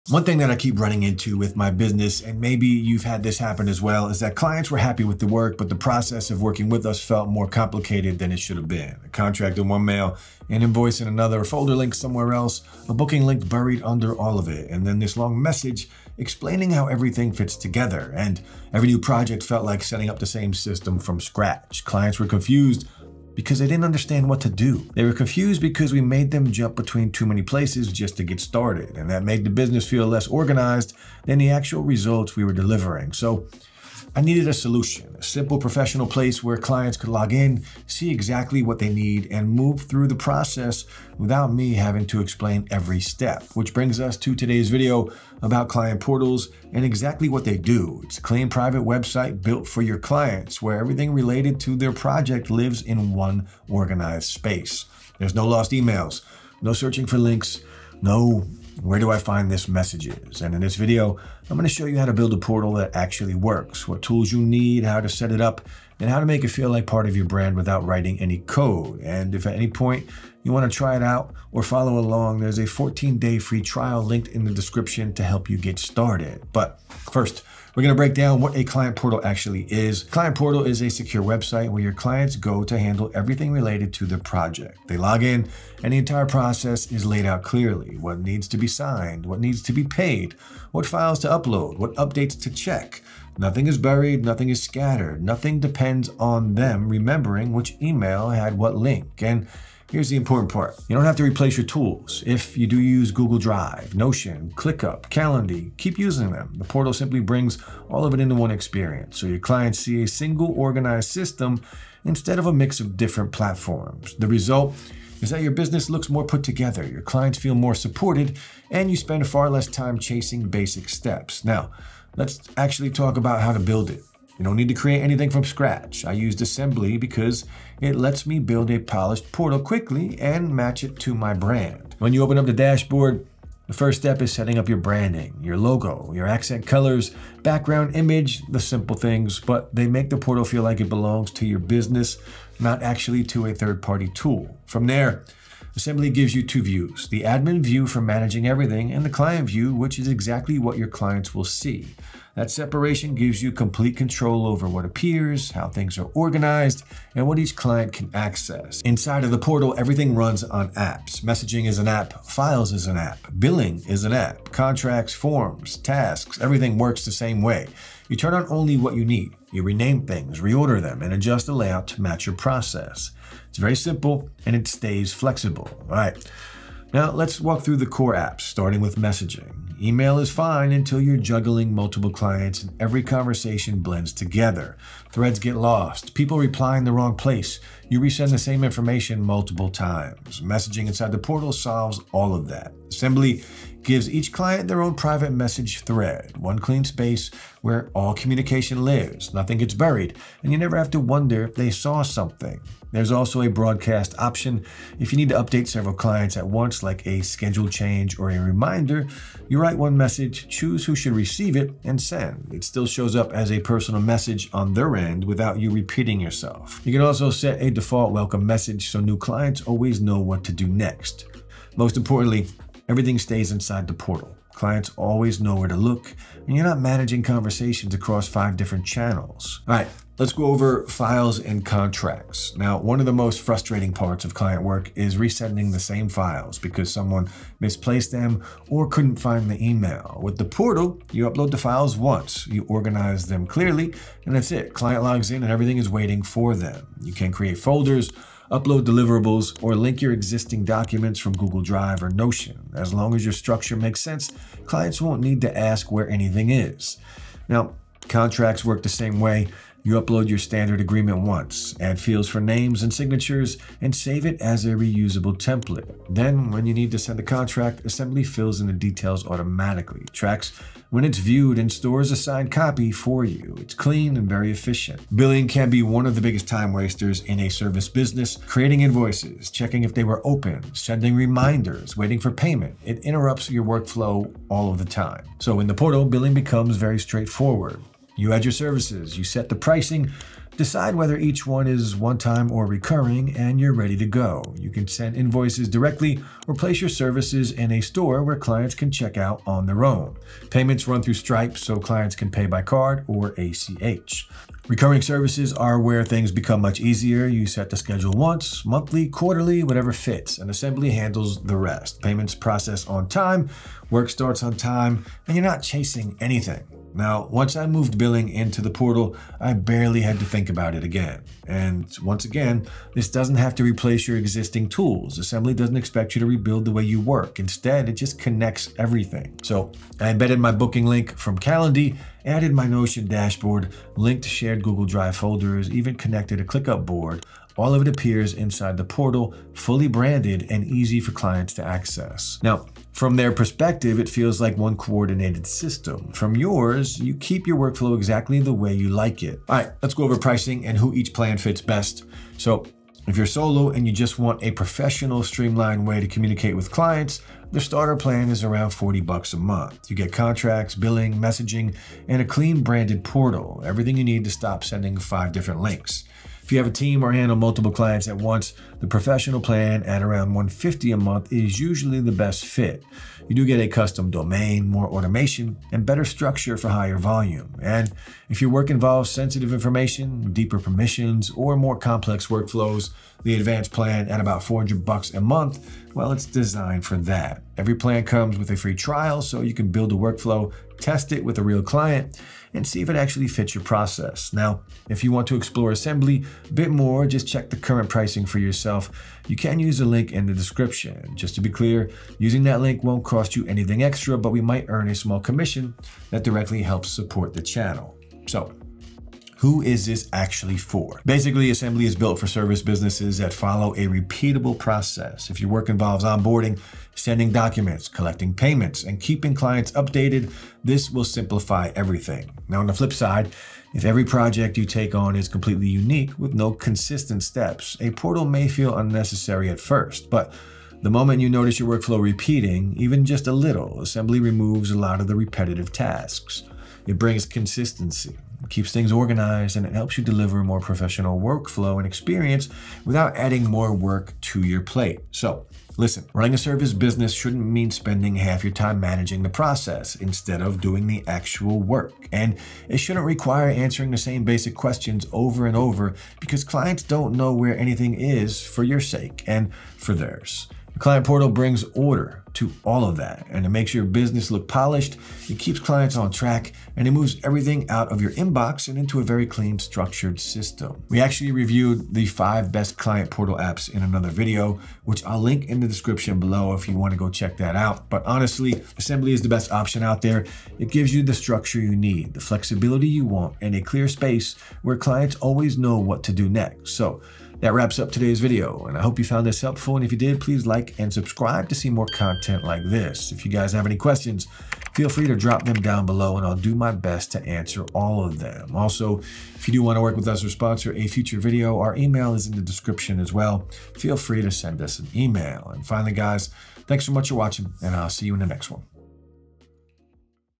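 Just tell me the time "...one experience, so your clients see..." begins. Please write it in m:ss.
1:48.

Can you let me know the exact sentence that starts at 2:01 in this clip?
Now, let's actually talk about how to build it.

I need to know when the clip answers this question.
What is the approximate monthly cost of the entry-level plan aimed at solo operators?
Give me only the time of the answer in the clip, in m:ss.
5:58.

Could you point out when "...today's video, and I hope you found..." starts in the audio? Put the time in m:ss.
8:07.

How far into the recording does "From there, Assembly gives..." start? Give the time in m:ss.
2:24.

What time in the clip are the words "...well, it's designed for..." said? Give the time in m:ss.
6:25.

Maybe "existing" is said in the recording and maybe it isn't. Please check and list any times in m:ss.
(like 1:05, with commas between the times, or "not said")
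4:10, 5:24.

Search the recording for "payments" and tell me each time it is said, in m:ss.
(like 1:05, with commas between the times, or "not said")
4:42, 5:00, 5:12, 6:58.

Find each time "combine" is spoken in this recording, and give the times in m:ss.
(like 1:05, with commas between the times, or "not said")
not said.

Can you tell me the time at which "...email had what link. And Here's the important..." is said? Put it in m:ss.
1:37.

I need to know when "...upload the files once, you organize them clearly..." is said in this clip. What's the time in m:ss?
4:01.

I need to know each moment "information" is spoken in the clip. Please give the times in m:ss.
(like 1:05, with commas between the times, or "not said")
3:08, 6:19.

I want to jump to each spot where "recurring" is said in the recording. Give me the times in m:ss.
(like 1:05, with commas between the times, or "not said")
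4:52, 5:04.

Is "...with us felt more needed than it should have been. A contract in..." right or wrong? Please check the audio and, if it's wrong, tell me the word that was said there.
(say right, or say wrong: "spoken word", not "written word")
wrong: "complicated", not "needed".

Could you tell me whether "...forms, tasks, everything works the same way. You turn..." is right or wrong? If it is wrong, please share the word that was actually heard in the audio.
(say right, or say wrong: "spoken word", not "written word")
right.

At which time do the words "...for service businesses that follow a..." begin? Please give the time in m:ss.
6:52.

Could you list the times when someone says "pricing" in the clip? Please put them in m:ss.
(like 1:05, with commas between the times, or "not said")
4:49, 5:50, 6:37.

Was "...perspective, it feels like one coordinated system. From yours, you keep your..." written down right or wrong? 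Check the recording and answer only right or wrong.
right.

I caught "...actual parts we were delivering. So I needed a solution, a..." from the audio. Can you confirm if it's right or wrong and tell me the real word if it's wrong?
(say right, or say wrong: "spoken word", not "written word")
wrong: "results", not "parts".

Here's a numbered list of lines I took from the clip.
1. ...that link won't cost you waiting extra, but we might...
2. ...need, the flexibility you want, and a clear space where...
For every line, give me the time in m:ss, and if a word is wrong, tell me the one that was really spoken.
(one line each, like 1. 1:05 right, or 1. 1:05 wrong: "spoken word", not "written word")
1. 6:42 wrong: "anything", not "waiting"
2. 8:01 right.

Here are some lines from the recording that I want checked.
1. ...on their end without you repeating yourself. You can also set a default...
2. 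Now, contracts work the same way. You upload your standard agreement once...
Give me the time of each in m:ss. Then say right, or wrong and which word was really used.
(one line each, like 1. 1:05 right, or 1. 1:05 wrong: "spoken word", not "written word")
1. 3:34 right
2. 4:17 right.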